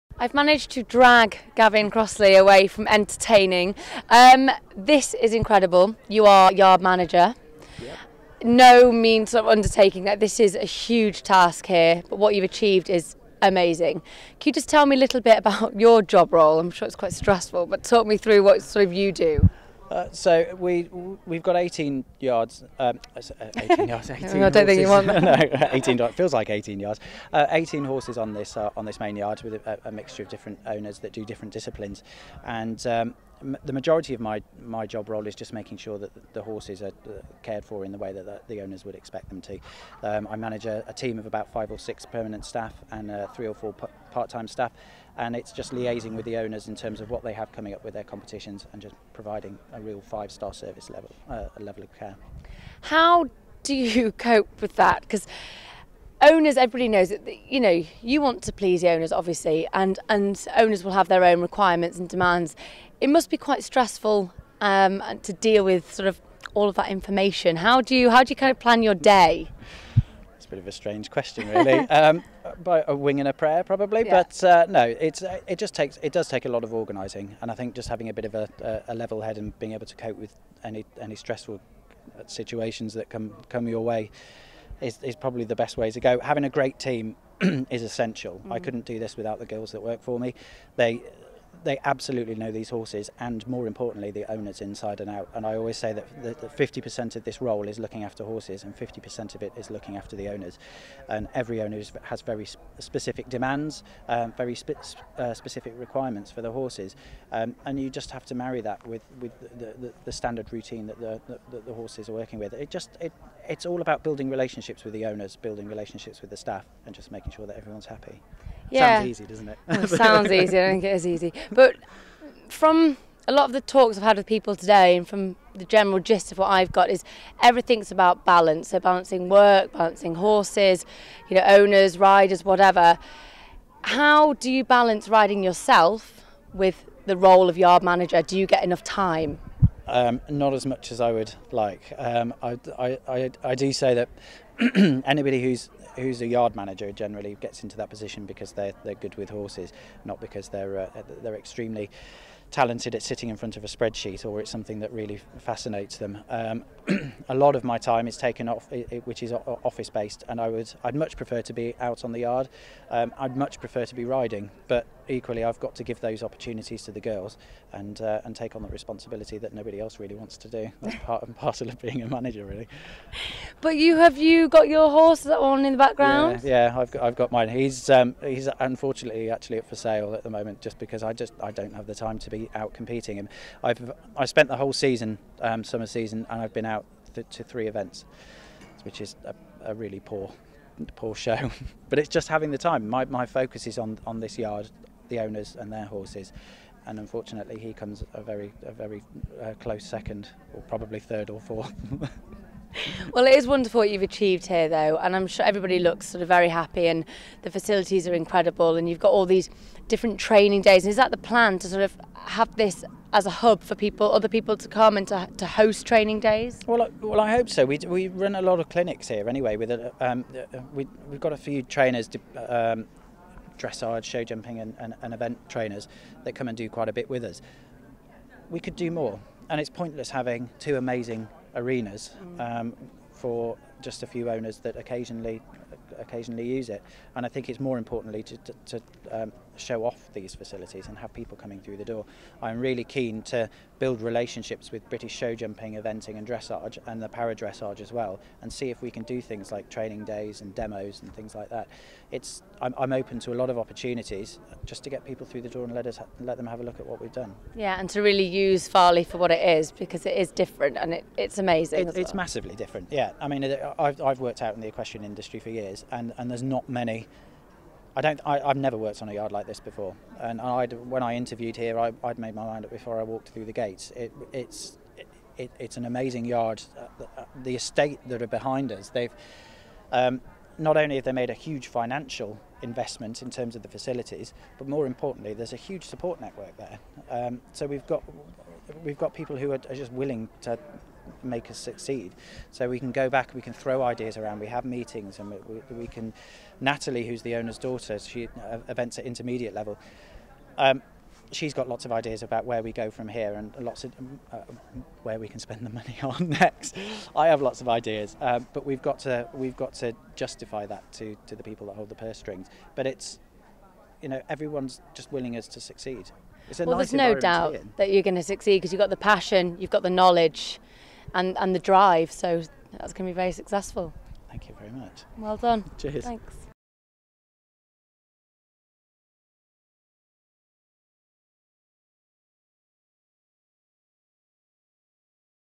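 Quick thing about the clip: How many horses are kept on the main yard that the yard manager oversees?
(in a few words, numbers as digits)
18.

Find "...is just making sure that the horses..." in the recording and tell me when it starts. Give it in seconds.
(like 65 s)
35 s.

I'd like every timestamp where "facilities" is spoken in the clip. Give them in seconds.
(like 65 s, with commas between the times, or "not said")
207 s, 240 s, 283 s.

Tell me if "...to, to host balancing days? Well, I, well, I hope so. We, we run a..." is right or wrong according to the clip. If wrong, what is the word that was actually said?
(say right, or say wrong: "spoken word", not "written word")
wrong: "training", not "balancing".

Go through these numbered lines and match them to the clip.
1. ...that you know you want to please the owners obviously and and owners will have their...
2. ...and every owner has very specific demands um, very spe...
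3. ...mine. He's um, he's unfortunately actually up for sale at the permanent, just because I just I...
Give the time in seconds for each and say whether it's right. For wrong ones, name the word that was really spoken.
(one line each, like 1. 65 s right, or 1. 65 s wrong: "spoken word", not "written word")
1. 57 s right
2. 101 s right
3. 177 s wrong: "moment", not "permanent".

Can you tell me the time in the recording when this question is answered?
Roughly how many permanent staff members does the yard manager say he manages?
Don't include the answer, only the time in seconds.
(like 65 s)
41 s.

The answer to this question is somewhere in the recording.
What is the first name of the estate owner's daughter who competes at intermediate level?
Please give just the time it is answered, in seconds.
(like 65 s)
296 s.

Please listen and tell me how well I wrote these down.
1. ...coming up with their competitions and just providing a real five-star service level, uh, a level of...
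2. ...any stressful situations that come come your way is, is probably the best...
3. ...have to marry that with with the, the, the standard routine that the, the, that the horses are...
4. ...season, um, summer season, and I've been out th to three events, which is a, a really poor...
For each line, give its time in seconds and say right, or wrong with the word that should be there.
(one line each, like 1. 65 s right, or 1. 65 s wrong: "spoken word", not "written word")
1. 47 s right
2. 81 s right
3. 108 s right
4. 184 s right.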